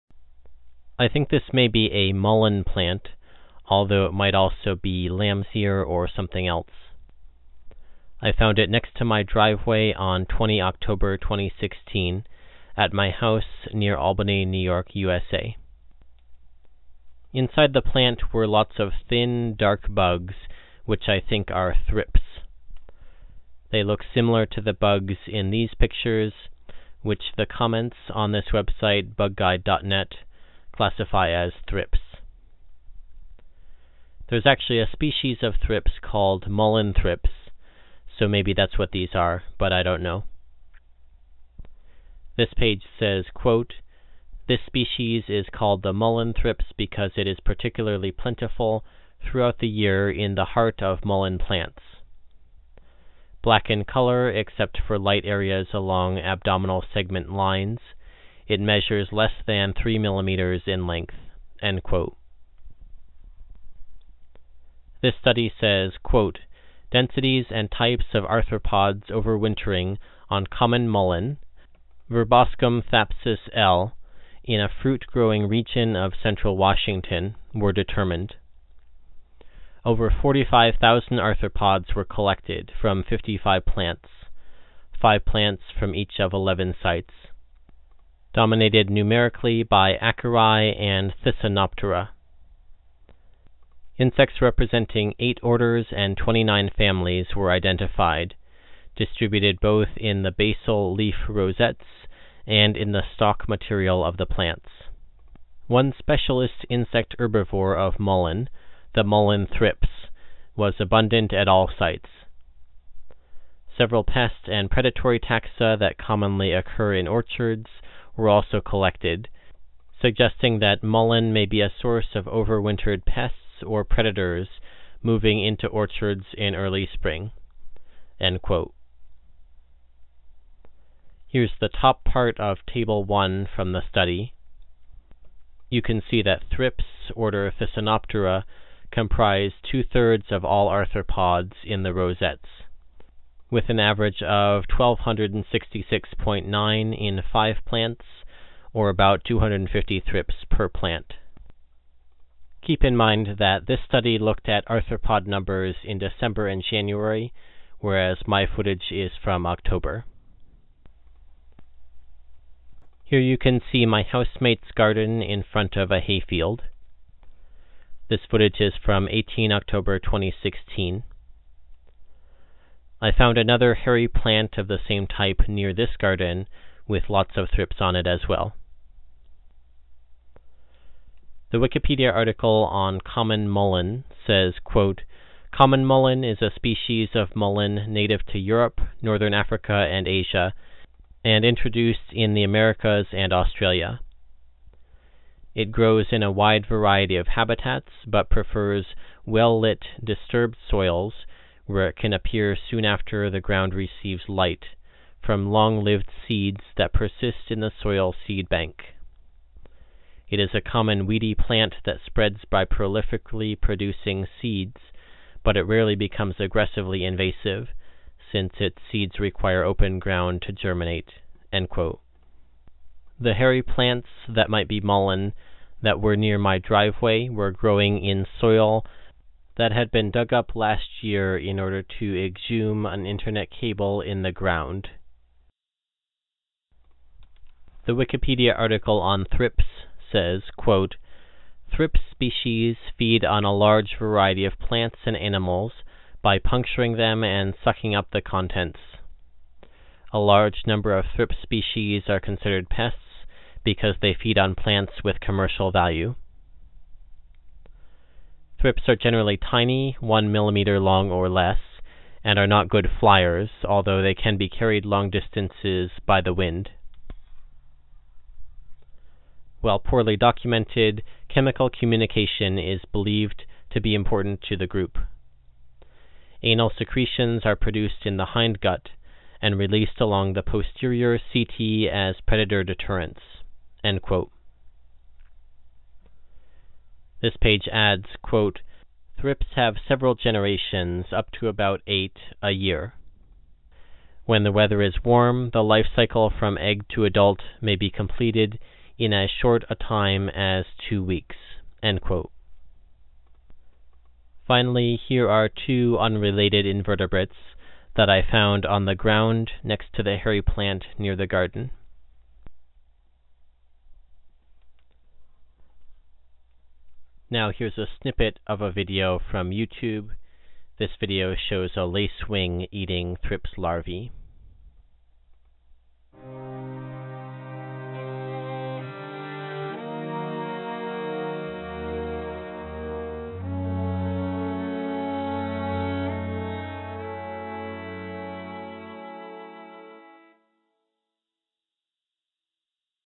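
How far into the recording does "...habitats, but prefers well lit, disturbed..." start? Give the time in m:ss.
3:17.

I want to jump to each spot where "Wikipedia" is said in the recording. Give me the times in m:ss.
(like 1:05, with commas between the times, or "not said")
3:01, 3:57.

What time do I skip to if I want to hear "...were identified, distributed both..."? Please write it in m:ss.
1:37.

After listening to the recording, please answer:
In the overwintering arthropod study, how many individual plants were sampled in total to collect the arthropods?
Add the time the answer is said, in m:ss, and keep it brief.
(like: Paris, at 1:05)
55, at 1:23.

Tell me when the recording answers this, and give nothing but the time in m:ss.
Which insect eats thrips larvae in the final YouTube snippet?
5:21.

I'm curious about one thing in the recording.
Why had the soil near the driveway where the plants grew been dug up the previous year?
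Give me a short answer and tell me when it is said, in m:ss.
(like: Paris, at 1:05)
to exhume an internet cable, at 3:52.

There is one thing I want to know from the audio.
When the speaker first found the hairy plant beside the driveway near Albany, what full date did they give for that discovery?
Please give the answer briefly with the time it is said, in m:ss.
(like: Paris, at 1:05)
20 October 2016, at 0:10.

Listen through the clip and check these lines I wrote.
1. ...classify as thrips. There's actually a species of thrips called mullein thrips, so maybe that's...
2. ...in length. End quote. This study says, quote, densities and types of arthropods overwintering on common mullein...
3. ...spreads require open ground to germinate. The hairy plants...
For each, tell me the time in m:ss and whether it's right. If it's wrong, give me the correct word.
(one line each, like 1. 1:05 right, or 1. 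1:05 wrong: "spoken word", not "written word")
1. 0:30 right
2. 1:00 right
3. 3:38 wrong: "seeds", not "spreads".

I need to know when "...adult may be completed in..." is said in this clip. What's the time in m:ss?
4:57.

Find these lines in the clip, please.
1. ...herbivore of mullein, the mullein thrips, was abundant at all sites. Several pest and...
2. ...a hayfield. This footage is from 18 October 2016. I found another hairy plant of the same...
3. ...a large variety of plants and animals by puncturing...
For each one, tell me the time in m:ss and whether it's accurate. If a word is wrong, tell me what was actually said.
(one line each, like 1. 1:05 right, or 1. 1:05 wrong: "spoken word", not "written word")
1. 1:47 right
2. 2:45 right
3. 4:03 right.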